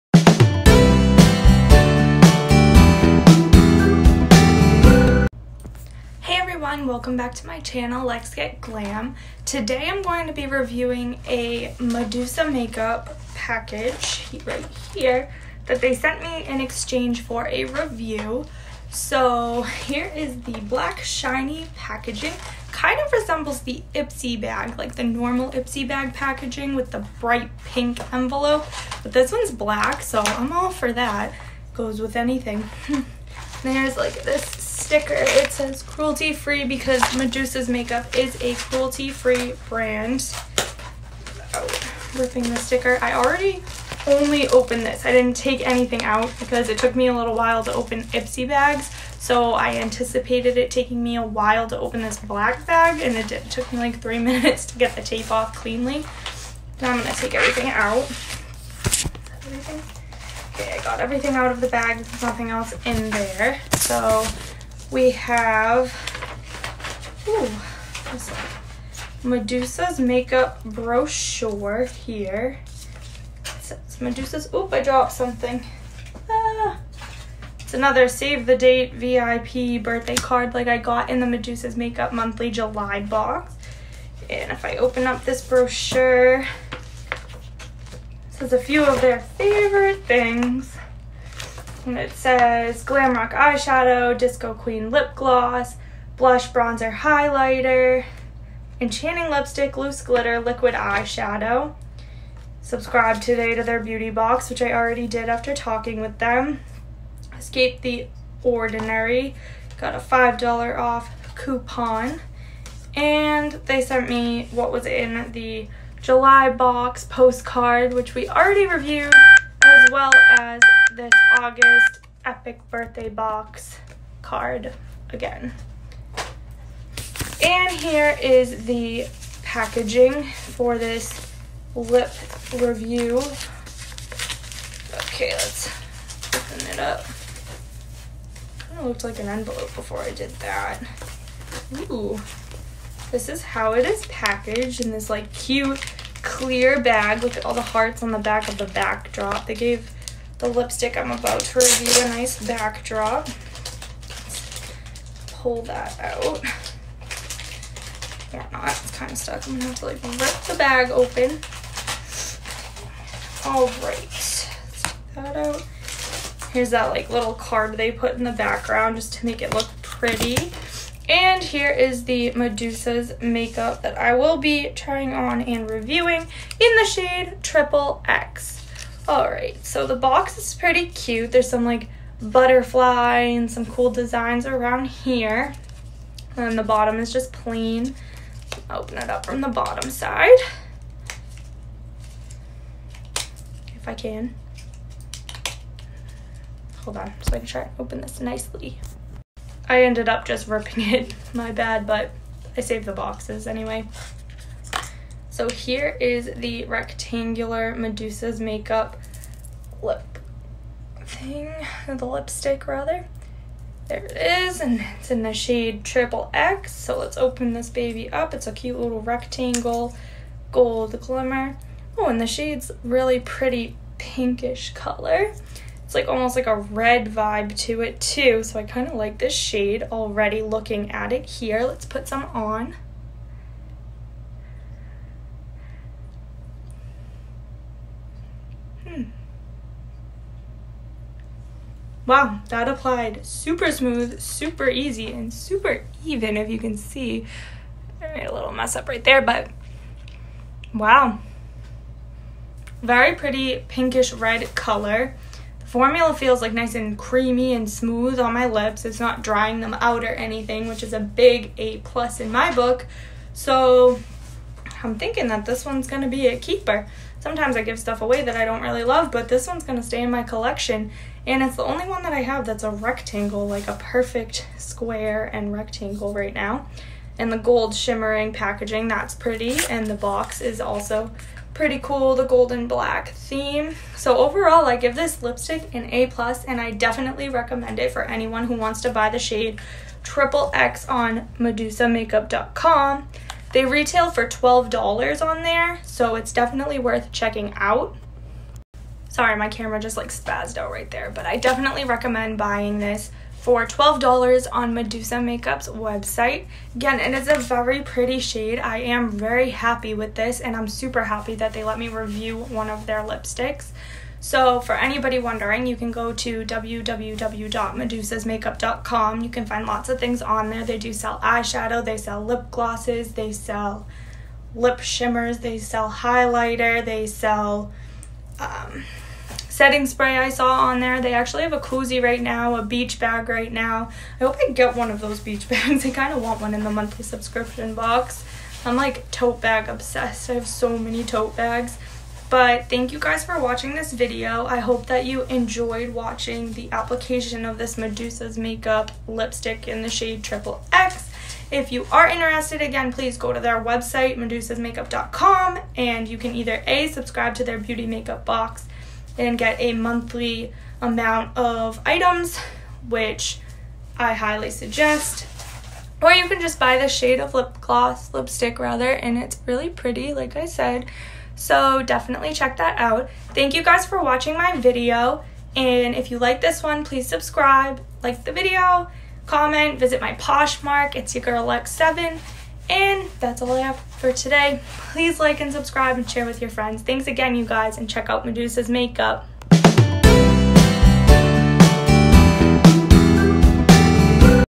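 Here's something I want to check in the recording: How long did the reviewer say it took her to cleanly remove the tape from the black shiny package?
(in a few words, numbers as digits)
3 minutes.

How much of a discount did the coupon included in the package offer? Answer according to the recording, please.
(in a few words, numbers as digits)
$5 off.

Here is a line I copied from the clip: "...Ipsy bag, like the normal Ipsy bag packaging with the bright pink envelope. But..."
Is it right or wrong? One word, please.
right.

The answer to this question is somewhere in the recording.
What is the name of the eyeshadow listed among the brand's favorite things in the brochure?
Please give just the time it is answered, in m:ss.
1:32.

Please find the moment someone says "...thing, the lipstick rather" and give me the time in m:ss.
3:31.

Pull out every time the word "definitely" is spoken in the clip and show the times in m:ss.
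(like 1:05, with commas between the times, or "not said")
4:46, 4:56, 5:01, 6:11.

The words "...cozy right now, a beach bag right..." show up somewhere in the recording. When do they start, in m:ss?
5:31.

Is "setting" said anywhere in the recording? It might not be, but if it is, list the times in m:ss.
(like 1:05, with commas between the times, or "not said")
5:29.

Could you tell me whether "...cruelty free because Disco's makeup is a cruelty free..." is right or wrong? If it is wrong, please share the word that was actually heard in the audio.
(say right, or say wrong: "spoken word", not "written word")
wrong: "Medusa", not "Disco".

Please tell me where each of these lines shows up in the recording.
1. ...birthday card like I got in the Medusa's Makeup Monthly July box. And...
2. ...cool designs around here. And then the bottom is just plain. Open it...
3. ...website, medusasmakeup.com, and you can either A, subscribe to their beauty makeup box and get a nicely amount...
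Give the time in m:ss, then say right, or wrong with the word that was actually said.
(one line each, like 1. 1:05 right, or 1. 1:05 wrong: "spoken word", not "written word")
1. 1:19 right
2. 3:03 right
3. 5:53 wrong: "monthly", not "nicely".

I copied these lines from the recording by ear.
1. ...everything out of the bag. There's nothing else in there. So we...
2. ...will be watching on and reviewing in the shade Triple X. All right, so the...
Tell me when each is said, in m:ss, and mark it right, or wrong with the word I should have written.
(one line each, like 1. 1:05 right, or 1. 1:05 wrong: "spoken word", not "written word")
1. 1:00 right
2. 2:54 wrong: "trying", not "watching".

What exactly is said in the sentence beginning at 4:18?
It's not drying them out or anything, which is a big A plus in my book.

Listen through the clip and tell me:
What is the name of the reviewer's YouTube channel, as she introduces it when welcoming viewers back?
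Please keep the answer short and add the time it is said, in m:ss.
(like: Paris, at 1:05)
Lex Get Glam, at 0:08.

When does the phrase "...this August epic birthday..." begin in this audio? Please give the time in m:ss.
2:00.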